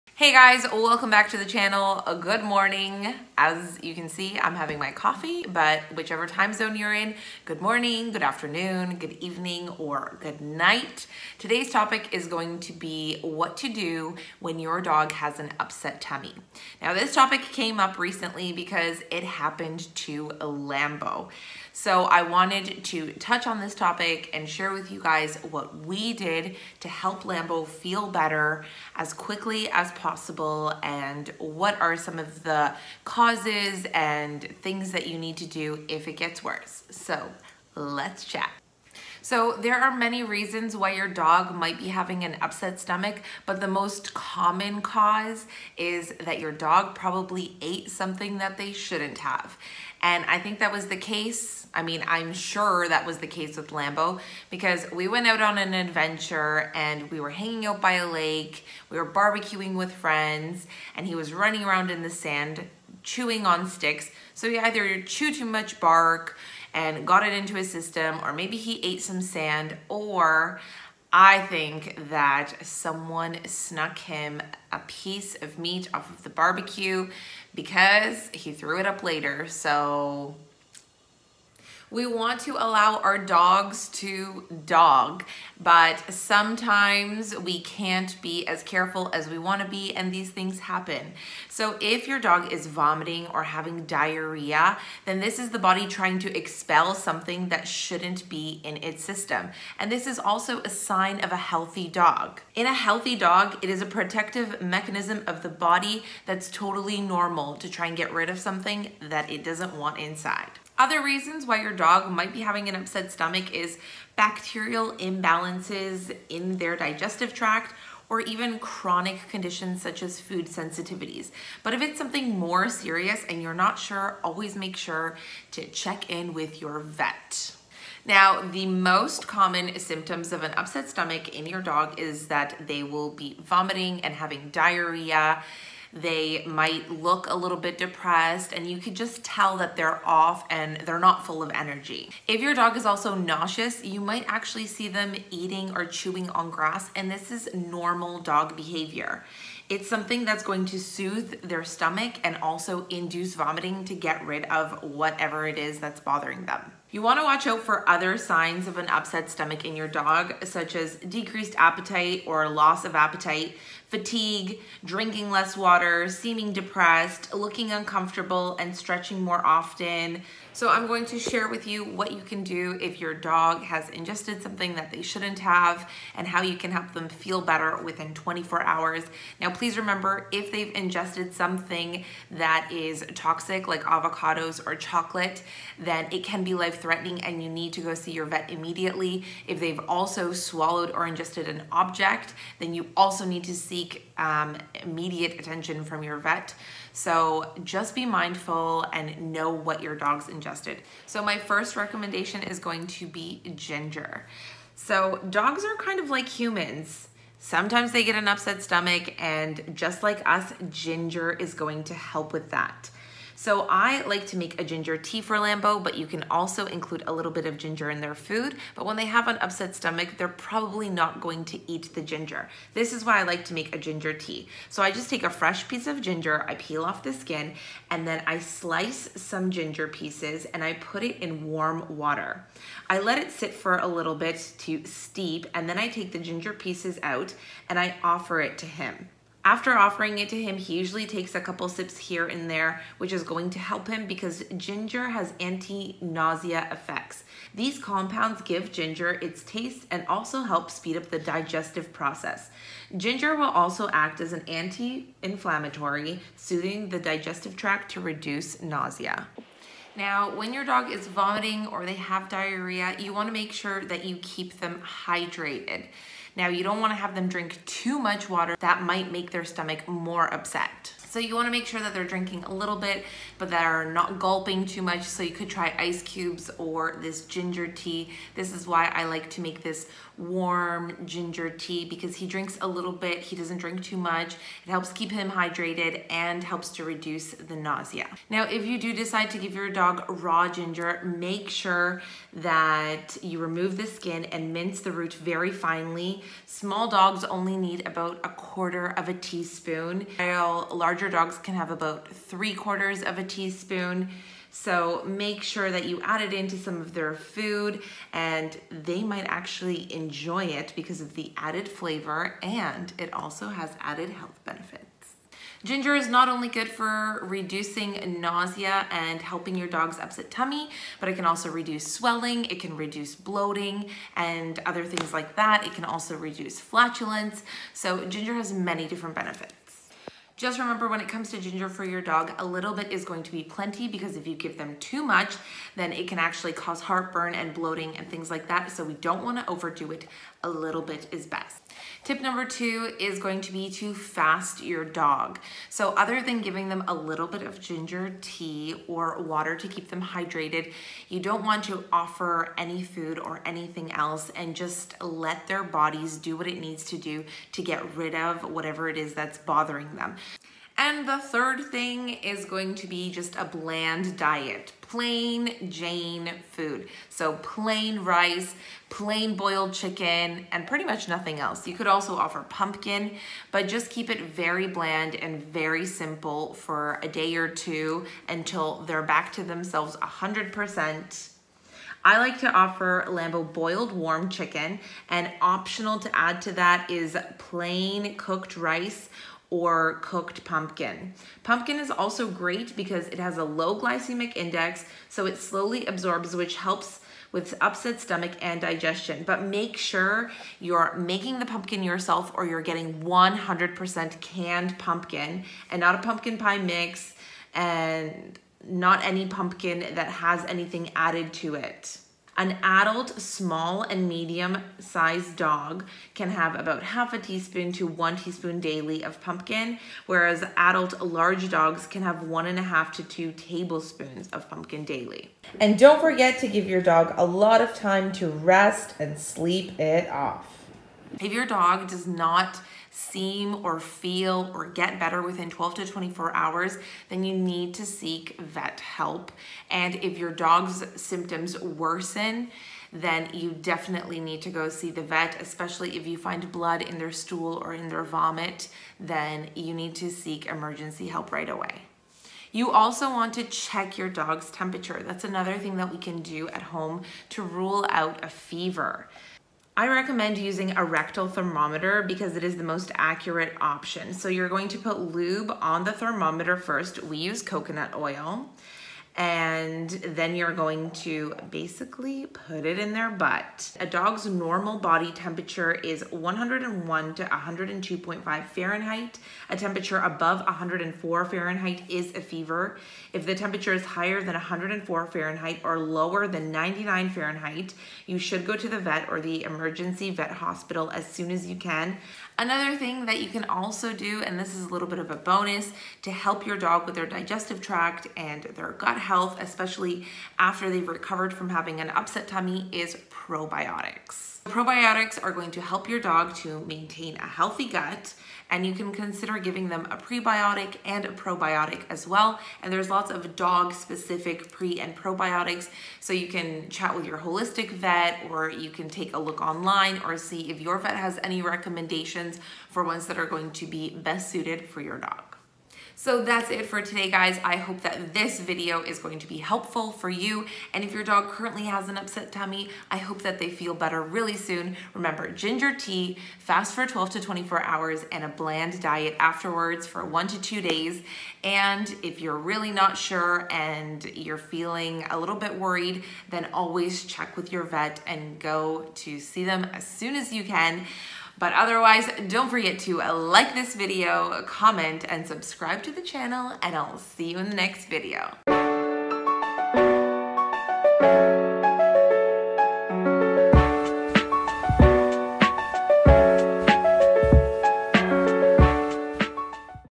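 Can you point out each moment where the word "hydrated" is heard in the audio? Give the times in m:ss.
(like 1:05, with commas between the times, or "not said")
4:25, 4:45, 5:50.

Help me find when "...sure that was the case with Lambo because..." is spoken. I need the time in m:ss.
0:52.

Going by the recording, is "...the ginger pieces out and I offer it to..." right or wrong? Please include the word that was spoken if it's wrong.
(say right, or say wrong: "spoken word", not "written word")
right.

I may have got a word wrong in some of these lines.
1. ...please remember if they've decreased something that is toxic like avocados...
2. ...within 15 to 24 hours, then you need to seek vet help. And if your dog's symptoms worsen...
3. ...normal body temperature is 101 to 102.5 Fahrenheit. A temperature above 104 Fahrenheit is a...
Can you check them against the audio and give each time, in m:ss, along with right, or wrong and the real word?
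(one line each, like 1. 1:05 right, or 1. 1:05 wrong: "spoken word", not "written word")
1. 2:59 wrong: "ingested", not "decreased"
2. 7:15 wrong: "12", not "15"
3. 7:54 right.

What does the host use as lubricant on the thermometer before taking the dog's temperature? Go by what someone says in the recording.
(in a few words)
Coconut oil.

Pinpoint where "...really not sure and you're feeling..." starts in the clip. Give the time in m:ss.
9:02.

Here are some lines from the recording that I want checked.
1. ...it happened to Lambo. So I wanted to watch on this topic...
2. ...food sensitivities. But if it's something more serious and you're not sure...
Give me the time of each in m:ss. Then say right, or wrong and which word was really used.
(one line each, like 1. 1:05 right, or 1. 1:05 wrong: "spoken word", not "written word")
1. 0:19 wrong: "touch", not "watch"
2. 2:00 right.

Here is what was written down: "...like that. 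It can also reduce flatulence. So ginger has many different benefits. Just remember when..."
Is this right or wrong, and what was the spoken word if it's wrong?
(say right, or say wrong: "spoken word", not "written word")
right.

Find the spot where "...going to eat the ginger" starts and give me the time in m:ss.
3:41.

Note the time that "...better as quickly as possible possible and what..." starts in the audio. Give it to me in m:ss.
0:28.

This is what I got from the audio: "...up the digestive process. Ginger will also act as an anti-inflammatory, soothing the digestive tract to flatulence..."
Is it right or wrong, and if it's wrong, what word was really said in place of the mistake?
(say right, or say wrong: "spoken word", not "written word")
wrong: "reduce", not "flatulence".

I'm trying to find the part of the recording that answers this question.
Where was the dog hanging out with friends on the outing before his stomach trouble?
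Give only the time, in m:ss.
0:57.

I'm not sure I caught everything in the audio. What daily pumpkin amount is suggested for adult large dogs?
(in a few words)
1.5 to 2 tablespoons.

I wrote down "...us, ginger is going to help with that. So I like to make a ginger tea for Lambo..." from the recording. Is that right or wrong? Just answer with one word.
right.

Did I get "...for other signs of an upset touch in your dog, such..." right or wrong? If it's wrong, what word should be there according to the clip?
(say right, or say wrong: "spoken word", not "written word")
wrong: "stomach", not "touch".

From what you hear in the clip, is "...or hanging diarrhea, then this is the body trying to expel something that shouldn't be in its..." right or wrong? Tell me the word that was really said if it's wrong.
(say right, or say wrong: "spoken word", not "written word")
wrong: "having", not "hanging".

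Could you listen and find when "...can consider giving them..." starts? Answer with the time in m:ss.
8:28.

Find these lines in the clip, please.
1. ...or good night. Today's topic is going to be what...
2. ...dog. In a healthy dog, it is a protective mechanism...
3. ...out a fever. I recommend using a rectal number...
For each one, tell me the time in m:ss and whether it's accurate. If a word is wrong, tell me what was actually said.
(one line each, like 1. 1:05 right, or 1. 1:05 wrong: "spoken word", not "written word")
1. 0:09 right
2. 1:41 right
3. 7:37 wrong: "thermometer", not "number".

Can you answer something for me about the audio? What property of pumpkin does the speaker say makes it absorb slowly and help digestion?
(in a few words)
Low glycemic index.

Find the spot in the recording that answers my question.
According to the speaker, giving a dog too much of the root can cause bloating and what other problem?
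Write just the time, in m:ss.
5:36.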